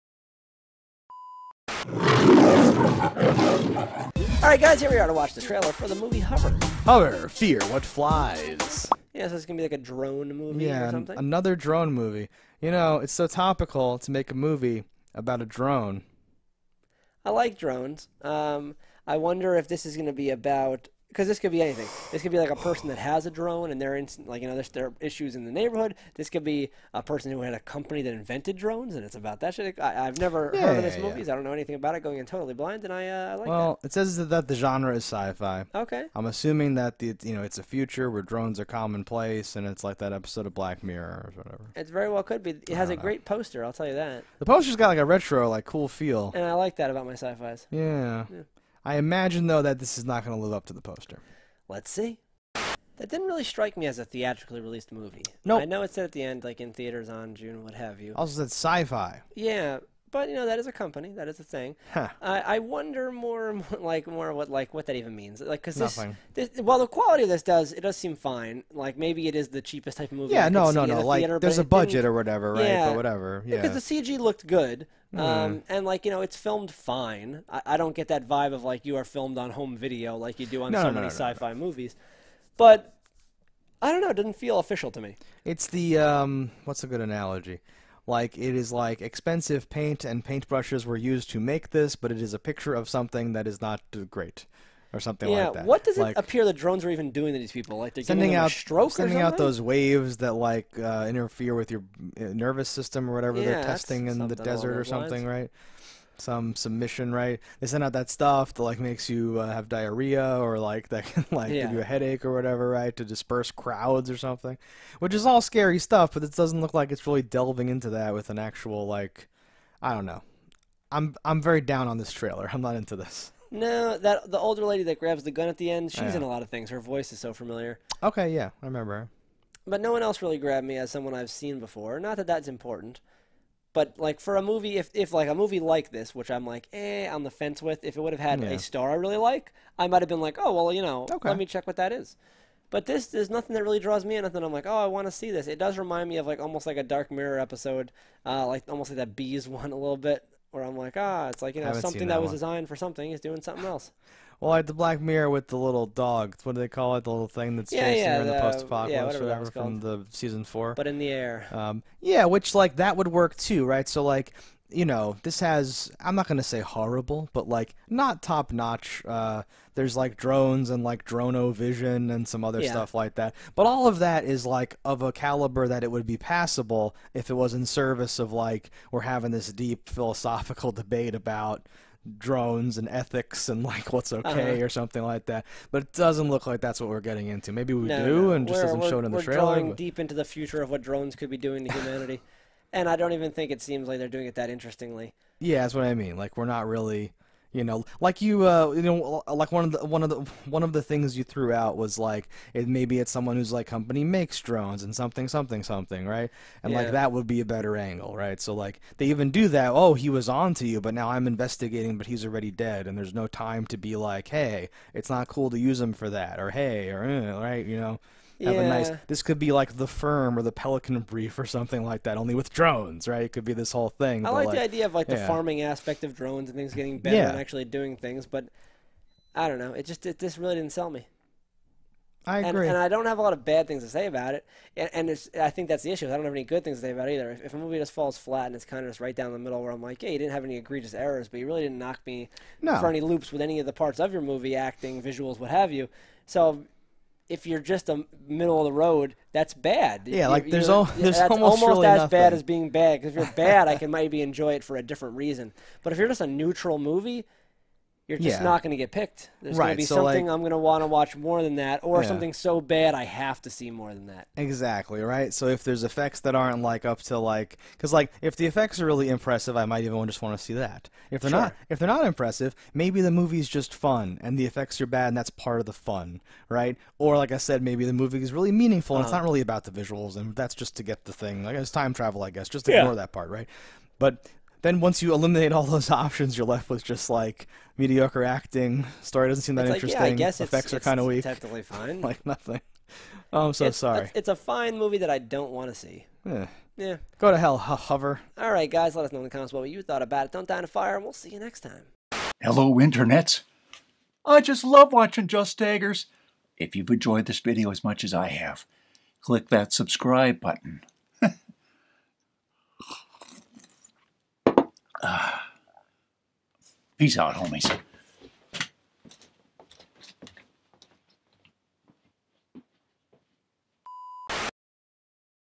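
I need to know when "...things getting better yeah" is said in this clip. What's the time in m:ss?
3:46.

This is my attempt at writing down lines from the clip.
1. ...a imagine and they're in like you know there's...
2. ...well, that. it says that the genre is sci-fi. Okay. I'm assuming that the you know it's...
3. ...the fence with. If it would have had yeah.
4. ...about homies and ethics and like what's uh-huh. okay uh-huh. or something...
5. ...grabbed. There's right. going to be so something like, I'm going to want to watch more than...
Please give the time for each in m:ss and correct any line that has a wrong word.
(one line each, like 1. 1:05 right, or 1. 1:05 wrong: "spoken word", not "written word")
1. 0:23 wrong: "drone", not "imagine"
2. 0:33 right
3. 2:17 right
4. 3:01 wrong: "drones", not "homies"
5. 4:18 wrong: "picked", not "grabbed".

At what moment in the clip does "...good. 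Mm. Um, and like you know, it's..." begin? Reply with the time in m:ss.
1:14.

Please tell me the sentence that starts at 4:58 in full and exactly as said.
Let us know in the comments what you thought about it.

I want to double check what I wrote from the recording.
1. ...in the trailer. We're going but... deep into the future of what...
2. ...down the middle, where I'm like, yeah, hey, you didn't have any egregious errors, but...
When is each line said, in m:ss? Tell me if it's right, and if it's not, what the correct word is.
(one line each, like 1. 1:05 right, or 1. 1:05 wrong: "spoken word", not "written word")
1. 3:09 right
2. 3:59 right.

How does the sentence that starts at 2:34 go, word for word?
well, like the Black Mirror with the little dog.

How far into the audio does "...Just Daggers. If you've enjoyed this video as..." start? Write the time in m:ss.
5:05.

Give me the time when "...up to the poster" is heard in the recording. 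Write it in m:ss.
0:50.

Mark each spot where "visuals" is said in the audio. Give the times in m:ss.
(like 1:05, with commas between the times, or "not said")
4:05, 4:39.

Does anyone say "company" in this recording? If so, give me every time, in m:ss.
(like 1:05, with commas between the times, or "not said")
0:27, 1:00, 3:23.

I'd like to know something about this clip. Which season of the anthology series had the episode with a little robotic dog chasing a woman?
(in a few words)
Season four.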